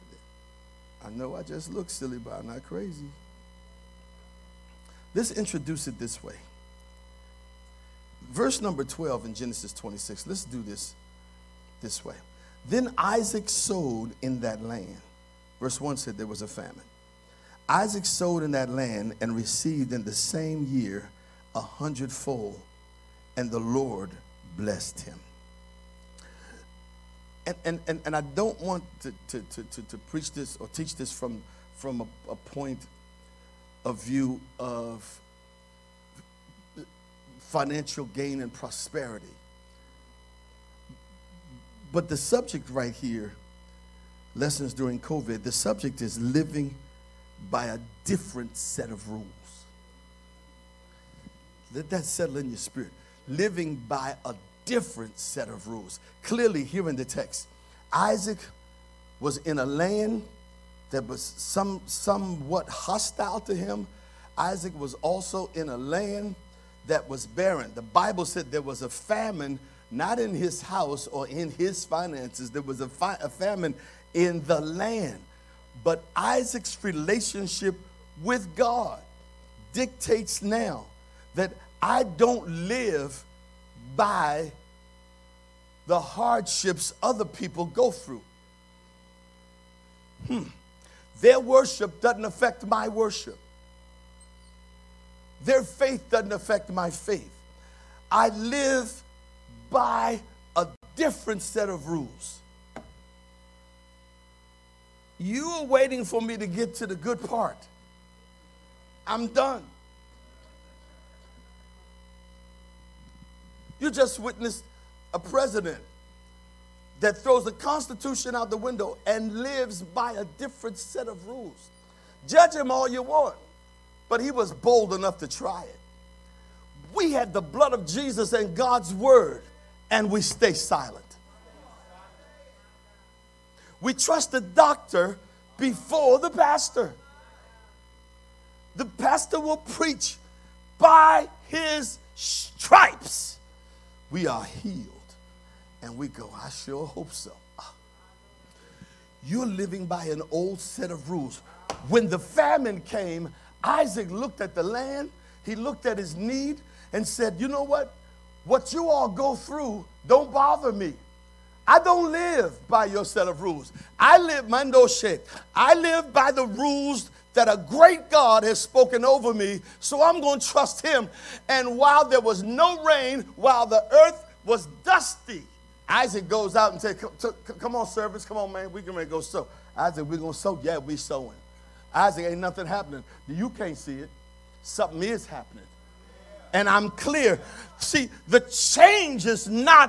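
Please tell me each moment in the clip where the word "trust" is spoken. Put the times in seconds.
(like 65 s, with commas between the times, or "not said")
133 s, 170 s.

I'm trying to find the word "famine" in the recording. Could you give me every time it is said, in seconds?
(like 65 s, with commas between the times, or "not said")
16 s, 68 s, 73 s, 152 s.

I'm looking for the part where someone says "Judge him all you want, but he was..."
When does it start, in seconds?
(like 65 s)
122 s.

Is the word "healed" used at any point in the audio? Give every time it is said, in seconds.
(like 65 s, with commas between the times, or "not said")
144 s.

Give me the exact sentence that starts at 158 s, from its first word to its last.
What you all go through don't bother me I don't live by your set of rules.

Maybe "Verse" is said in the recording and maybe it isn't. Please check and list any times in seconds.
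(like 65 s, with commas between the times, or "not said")
8 s, 15 s.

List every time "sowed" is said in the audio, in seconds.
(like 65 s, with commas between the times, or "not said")
13 s, 18 s.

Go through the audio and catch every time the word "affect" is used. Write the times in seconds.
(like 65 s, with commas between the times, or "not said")
92 s, 96 s.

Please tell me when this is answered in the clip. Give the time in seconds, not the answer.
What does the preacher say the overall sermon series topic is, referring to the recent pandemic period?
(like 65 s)
44 s.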